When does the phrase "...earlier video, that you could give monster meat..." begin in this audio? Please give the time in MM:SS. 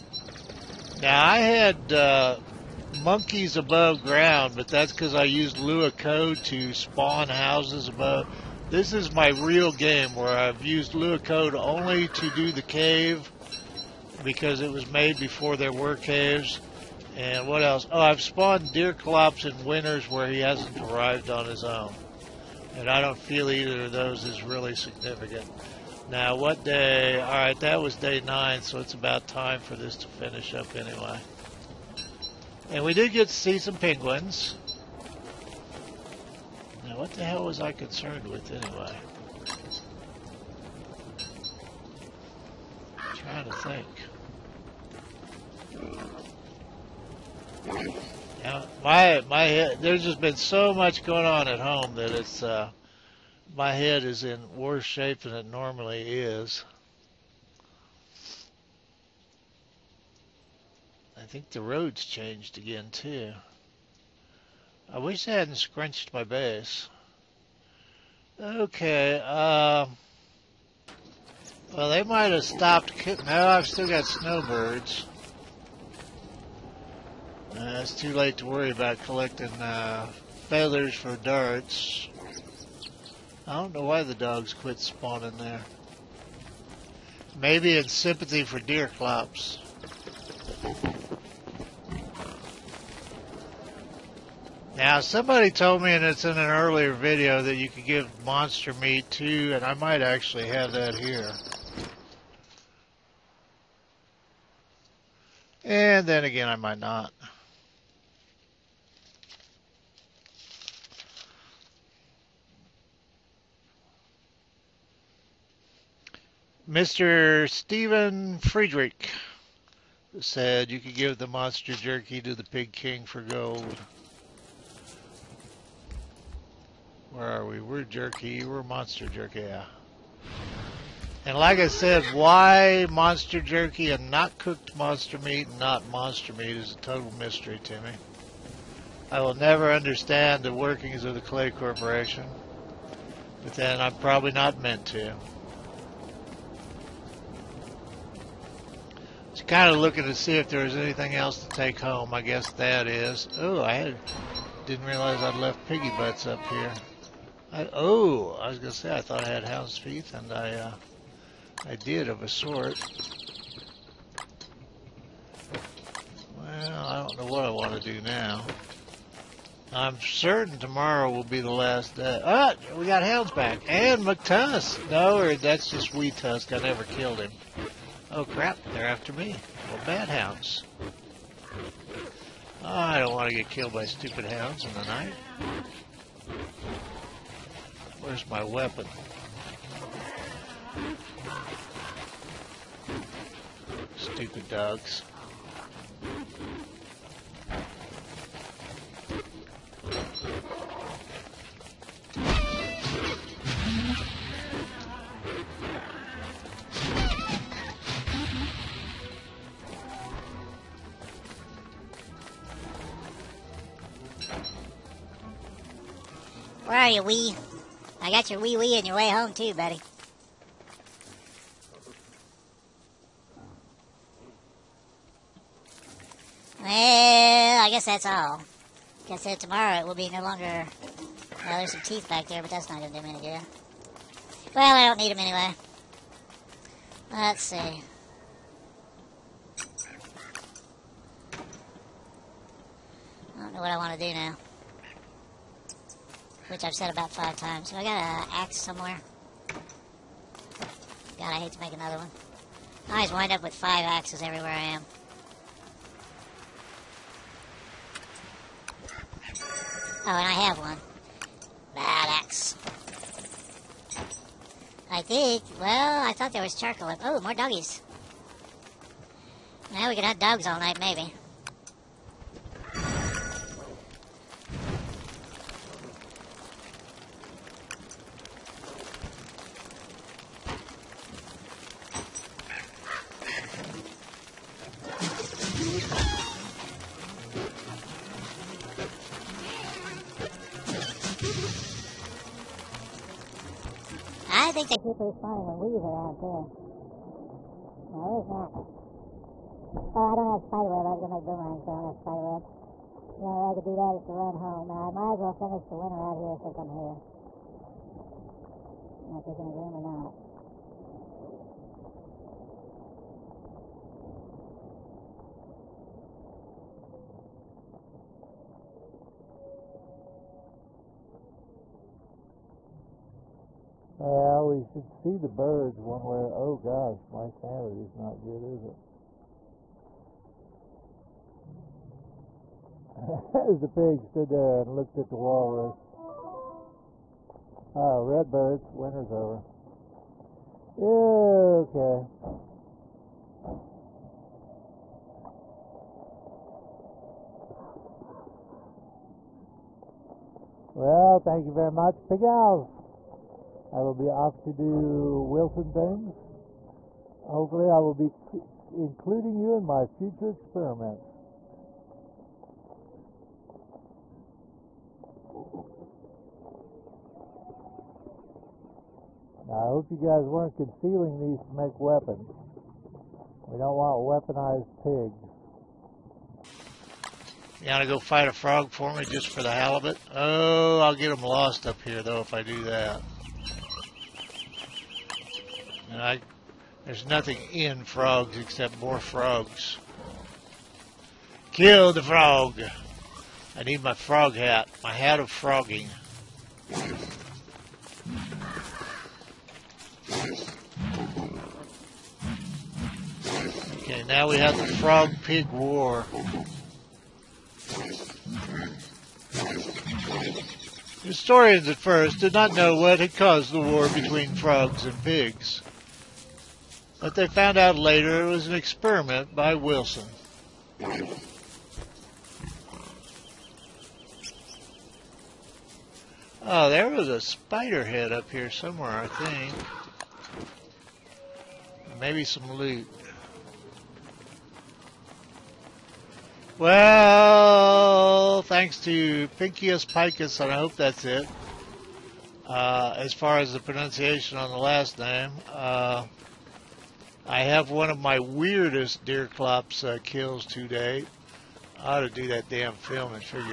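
01:36.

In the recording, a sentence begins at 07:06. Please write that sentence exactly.
Oh, there was a spider head up here somewhere, I think.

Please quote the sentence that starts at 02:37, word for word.
I, oh, I was gonna say I thought I had hound's teeth, and I uh, I did of a sort.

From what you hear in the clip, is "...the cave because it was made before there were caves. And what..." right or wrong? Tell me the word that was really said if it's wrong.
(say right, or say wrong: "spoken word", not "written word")
right.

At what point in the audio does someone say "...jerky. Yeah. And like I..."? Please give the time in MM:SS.
02:09.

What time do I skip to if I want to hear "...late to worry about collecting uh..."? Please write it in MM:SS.
01:18.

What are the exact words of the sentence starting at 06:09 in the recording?
Now, I hope you guys weren't concealing these to make weapons.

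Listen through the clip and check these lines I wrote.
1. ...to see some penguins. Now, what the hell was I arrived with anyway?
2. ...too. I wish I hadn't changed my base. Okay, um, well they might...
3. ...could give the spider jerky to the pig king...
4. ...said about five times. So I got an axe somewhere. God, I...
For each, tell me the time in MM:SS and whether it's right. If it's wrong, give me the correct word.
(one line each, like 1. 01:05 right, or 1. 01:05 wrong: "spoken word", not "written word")
1. 00:33 wrong: "concerned", not "arrived"
2. 01:02 wrong: "scrunched", not "changed"
3. 02:00 wrong: "monster", not "spider"
4. 04:06 right.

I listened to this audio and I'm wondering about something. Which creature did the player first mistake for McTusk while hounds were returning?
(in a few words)
Wee Tusk.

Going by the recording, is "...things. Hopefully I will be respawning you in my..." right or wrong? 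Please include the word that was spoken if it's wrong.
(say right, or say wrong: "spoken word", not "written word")
wrong: "including", not "respawning".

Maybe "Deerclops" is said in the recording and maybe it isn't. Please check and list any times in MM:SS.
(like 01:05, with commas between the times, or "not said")
00:18, 01:28, 07:29.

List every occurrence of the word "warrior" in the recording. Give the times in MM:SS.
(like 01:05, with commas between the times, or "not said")
not said.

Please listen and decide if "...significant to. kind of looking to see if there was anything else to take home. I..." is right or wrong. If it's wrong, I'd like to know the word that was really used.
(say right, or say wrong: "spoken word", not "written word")
wrong: "meant", not "significant".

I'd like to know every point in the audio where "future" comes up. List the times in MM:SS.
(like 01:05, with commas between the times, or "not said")
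05:59.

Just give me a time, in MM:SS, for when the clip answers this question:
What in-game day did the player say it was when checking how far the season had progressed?
00:27.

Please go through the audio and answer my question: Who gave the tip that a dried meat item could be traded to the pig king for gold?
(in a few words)
Stephen Friedrich.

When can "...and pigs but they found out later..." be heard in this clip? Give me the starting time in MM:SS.
06:54.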